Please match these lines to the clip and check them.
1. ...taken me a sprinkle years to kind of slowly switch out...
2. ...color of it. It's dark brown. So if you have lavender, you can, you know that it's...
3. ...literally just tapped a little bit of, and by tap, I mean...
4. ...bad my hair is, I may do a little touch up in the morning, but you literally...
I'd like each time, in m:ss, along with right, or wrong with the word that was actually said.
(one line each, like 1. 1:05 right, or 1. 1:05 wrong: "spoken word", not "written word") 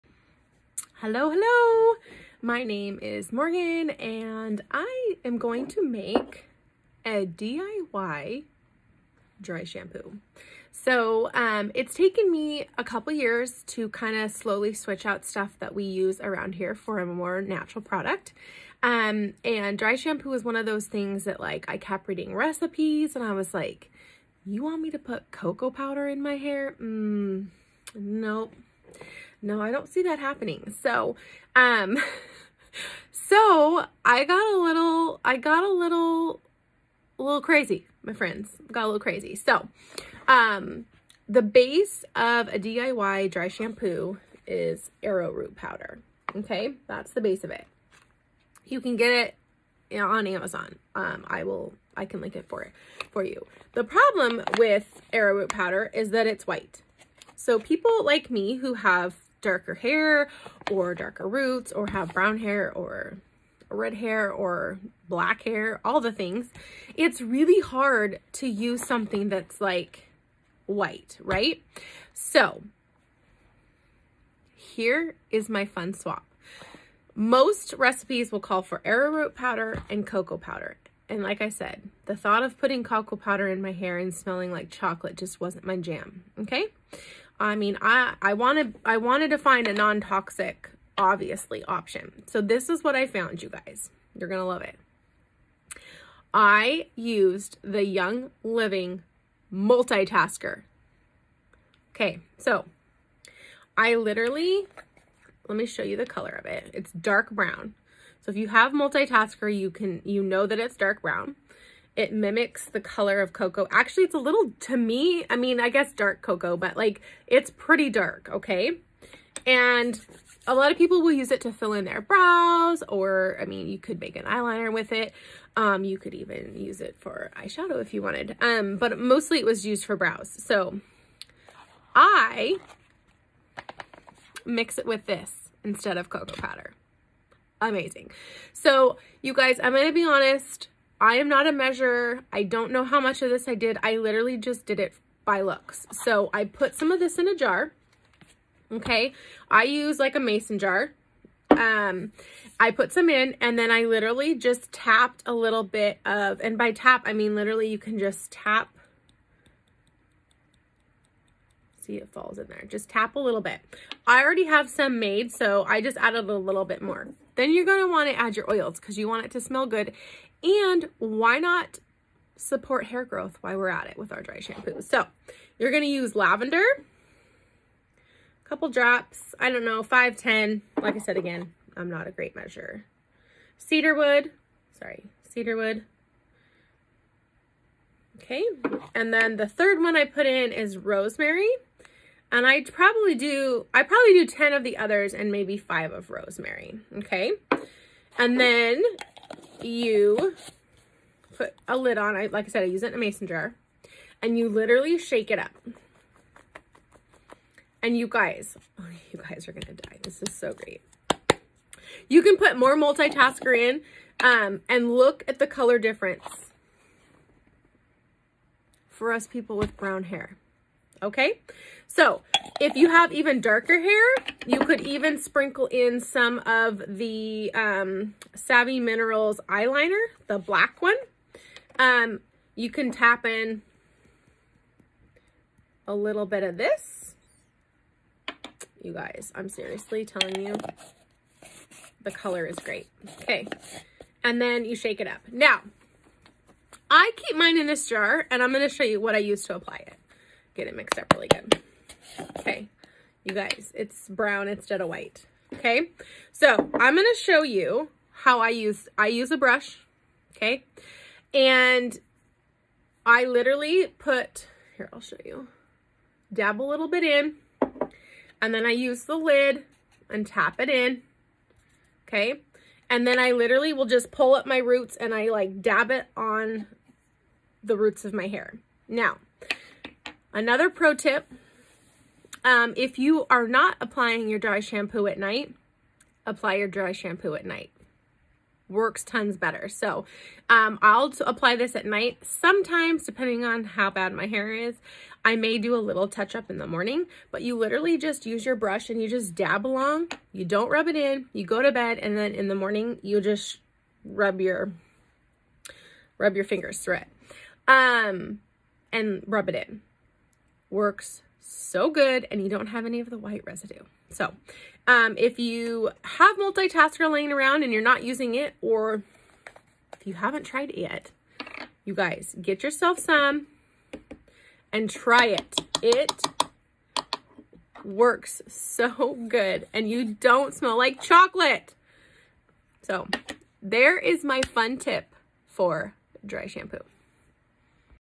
1. 0:11 wrong: "couple", not "sprinkle"
2. 1:46 wrong: "multitasker", not "lavender"
3. 2:33 right
4. 4:53 right.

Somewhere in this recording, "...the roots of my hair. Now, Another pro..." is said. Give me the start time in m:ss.
4:37.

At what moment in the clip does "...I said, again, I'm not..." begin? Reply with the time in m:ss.
3:00.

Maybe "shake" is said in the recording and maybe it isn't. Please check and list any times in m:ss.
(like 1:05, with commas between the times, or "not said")
3:24, 4:04.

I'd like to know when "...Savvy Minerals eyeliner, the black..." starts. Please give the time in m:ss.
3:48.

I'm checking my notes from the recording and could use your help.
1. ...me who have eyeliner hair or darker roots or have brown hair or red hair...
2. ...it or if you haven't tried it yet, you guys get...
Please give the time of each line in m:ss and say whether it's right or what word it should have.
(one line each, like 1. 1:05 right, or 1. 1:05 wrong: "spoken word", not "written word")
1. 0:58 wrong: "darker", not "eyeliner"
2. 5:18 right.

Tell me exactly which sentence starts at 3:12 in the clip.
And i probably do, I probably do 10 of the others and maybe five of rosemary, okay?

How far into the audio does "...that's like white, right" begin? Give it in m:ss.
1:09.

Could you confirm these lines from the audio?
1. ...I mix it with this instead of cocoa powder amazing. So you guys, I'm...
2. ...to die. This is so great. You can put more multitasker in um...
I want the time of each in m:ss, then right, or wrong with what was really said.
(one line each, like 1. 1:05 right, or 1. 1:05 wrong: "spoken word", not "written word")
1. 2:11 right
2. 3:29 right.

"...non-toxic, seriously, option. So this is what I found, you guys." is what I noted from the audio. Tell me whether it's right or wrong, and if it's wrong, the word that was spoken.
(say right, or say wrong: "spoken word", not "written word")
wrong: "obviously", not "seriously".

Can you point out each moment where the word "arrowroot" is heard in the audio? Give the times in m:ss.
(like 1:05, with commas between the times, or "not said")
0:45, 0:55, 1:18.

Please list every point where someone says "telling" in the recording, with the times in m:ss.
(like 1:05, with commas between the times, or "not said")
4:00.